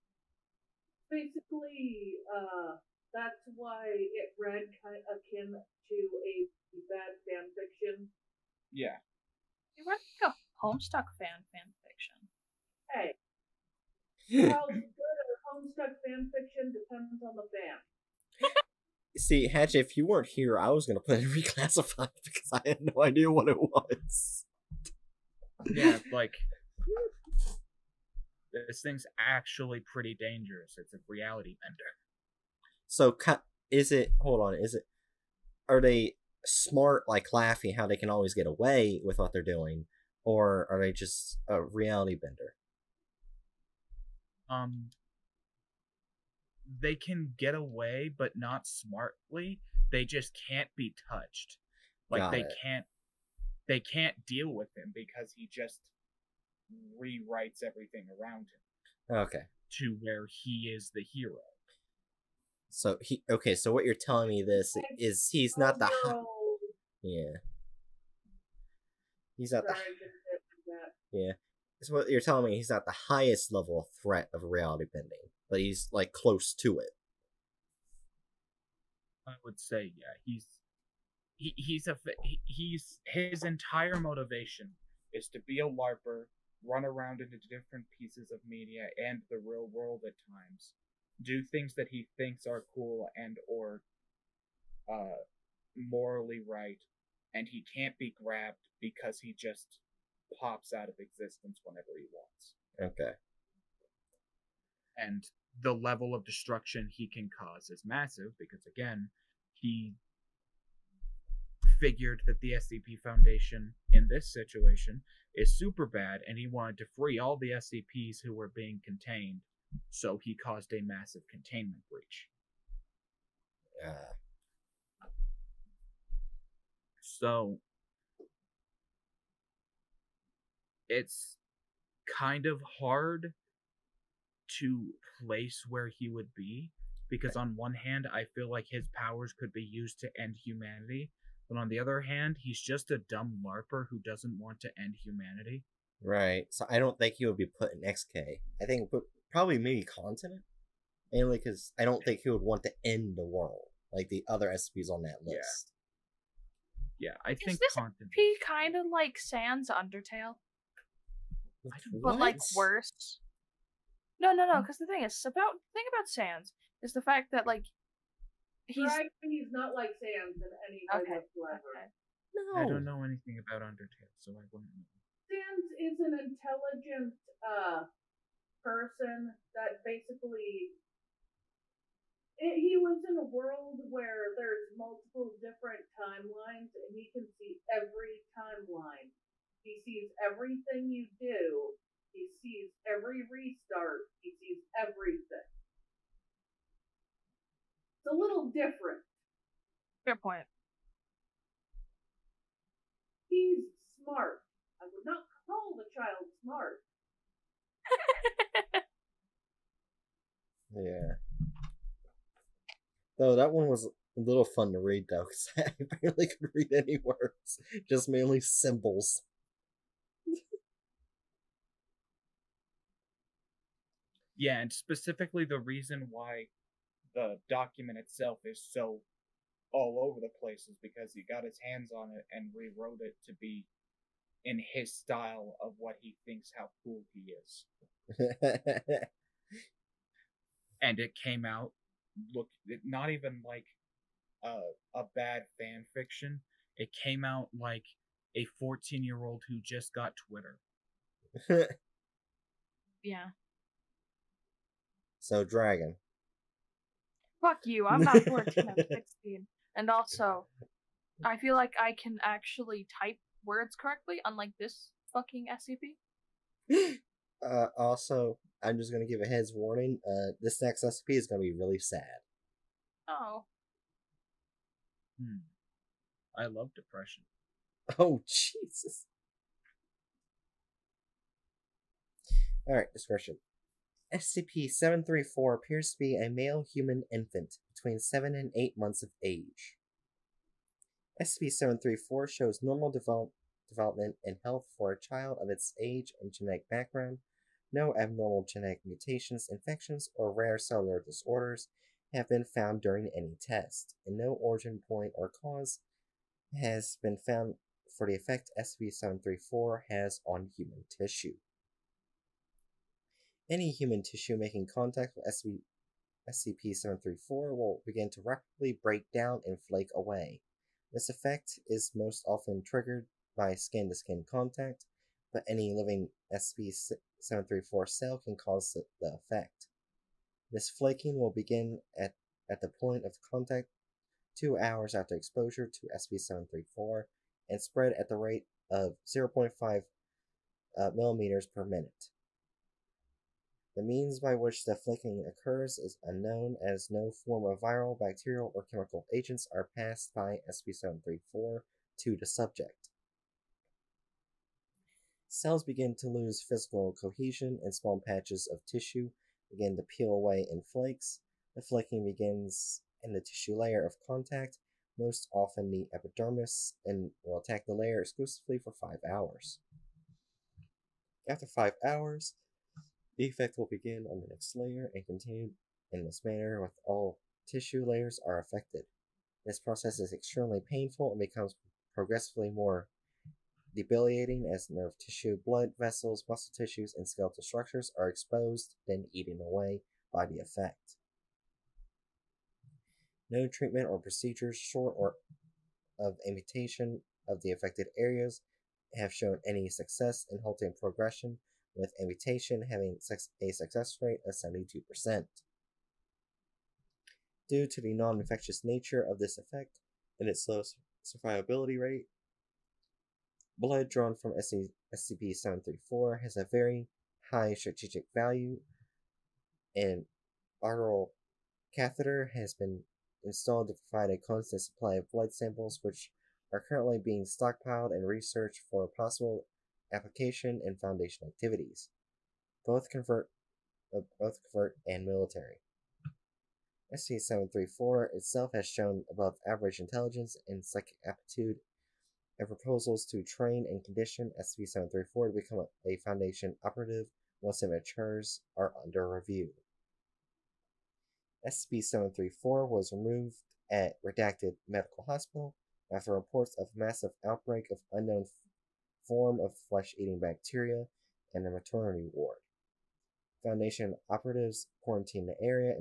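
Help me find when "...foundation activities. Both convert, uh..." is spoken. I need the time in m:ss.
7:10.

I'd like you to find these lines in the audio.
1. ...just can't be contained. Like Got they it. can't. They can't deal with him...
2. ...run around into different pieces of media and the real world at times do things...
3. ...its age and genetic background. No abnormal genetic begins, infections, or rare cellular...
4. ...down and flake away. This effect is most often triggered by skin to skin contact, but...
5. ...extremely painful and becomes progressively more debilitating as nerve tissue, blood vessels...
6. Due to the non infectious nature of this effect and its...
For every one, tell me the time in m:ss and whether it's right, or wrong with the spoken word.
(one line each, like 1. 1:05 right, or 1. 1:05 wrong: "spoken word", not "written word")
1. 0:50 wrong: "touched", not "contained"
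2. 1:26 right
3. 4:55 wrong: "mutations", not "begins"
4. 5:19 right
5. 6:20 right
6. 6:47 right.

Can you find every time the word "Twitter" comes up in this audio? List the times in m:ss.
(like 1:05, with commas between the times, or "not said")
4:10.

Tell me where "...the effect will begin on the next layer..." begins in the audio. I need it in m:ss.
6:13.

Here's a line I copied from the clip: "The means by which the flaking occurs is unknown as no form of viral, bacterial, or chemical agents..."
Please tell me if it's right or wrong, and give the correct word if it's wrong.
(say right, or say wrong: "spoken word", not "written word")
right.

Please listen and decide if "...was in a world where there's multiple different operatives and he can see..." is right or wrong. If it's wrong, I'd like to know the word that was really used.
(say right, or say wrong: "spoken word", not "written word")
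wrong: "timelines", not "operatives".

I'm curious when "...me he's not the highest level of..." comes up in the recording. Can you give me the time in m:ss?
1:12.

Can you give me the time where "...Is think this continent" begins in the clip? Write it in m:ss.
2:37.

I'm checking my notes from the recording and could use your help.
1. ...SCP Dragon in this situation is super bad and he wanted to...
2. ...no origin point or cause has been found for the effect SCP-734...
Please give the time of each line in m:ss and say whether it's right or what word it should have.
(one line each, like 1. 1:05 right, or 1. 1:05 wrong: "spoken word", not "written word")
1. 1:52 wrong: "Foundation", not "Dragon"
2. 5:04 right.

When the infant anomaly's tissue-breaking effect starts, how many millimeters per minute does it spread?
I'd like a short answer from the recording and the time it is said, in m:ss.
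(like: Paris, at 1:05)
0.5, at 5:39.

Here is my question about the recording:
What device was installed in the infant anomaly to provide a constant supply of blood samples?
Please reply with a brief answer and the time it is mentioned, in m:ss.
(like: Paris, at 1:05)
arterial catheter, at 7:00.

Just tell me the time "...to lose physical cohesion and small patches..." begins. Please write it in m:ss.
5:55.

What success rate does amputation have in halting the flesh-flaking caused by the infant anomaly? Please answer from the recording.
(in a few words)
72%.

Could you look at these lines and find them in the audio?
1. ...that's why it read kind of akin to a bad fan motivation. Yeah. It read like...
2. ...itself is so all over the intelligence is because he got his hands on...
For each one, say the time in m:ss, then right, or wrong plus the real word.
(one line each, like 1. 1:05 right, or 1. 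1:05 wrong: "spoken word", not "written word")
1. 0:03 wrong: "fiction", not "motivation"
2. 3:47 wrong: "place", not "intelligence".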